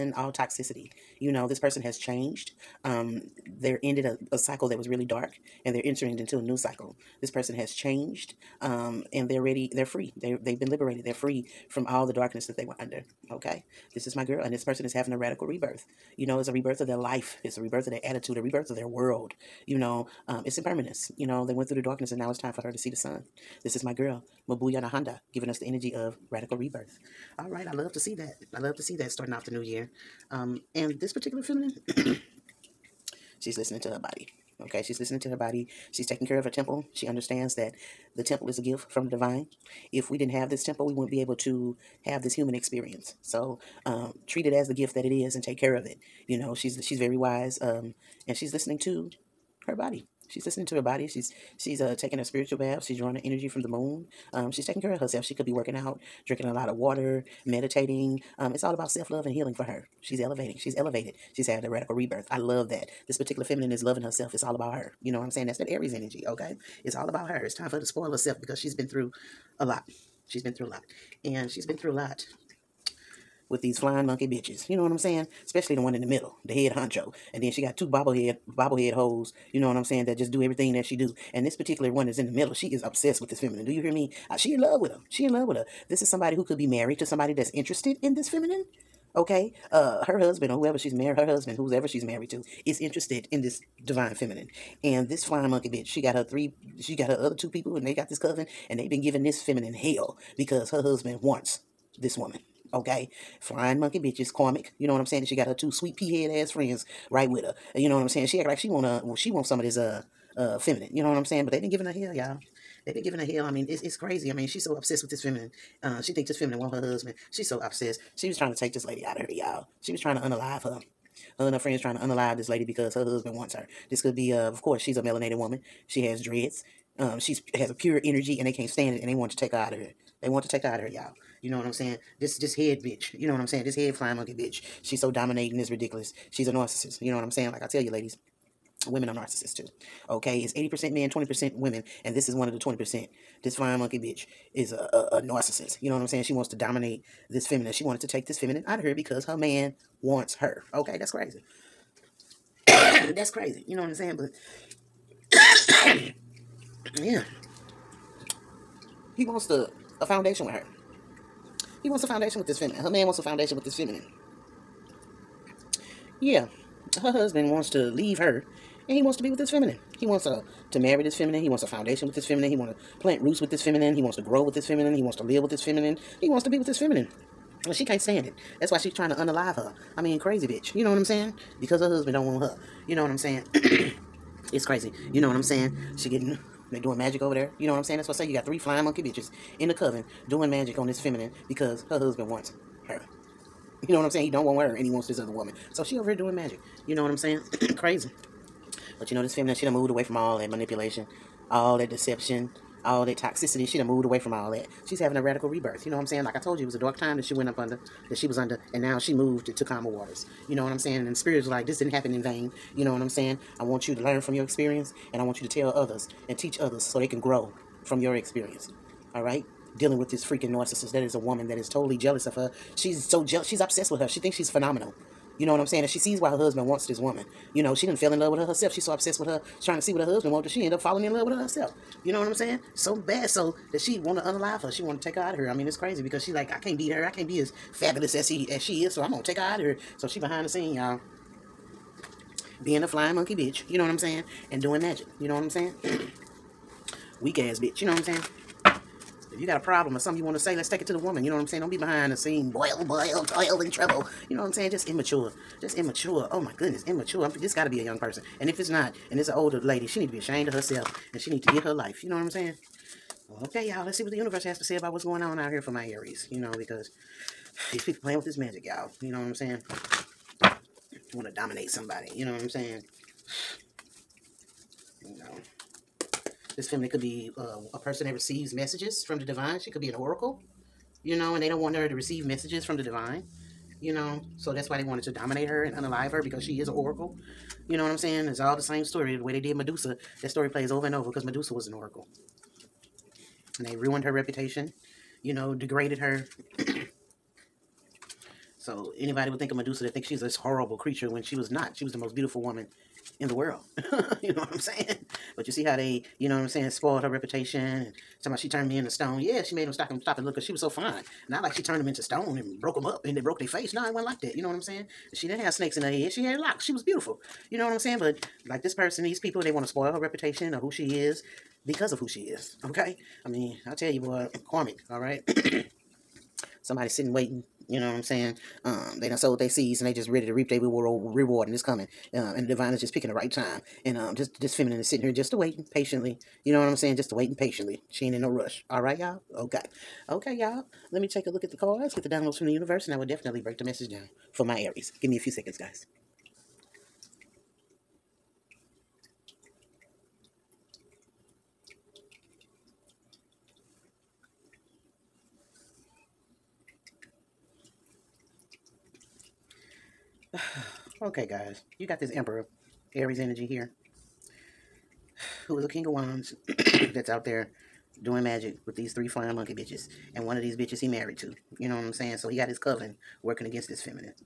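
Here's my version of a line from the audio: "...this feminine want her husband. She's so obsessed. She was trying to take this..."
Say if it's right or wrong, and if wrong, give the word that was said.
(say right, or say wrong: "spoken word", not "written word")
right.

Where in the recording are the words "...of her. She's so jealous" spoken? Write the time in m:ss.
3:42.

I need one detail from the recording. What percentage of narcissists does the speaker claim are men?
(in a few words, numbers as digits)
80%.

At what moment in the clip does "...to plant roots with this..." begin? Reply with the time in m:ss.
2:52.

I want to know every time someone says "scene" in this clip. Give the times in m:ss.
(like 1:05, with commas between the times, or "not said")
4:00, 4:12.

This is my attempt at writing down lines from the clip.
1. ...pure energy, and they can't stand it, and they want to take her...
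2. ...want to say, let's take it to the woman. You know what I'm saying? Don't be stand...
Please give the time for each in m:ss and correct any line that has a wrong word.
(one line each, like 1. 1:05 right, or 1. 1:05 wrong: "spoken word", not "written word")
1. 2:07 right
2. 4:10 wrong: "behind", not "stand".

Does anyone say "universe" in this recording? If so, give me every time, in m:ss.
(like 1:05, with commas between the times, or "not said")
4:24, 5:42.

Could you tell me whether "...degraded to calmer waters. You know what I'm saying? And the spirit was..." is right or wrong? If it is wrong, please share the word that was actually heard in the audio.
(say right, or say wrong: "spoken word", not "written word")
wrong: "moved", not "degraded".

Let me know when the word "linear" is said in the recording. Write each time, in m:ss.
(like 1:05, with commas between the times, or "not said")
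not said.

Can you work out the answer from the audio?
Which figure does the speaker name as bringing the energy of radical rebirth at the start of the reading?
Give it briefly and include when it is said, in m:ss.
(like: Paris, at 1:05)
Mabuya Nahanda, at 0:24.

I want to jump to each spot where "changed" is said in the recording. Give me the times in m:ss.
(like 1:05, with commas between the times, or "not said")
0:01, 0:07.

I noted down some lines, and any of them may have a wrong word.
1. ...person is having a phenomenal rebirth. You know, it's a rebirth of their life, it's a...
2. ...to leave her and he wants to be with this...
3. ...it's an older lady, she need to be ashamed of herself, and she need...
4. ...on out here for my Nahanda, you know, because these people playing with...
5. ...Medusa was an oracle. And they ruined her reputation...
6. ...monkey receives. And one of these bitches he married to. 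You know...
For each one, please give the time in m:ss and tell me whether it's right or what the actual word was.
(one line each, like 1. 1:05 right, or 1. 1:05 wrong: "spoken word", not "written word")
1. 0:14 wrong: "radical", not "phenomenal"
2. 2:47 right
3. 4:19 right
4. 4:25 wrong: "Aries", not "Nahanda"
5. 4:51 right
6. 6:09 wrong: "bitches", not "receives".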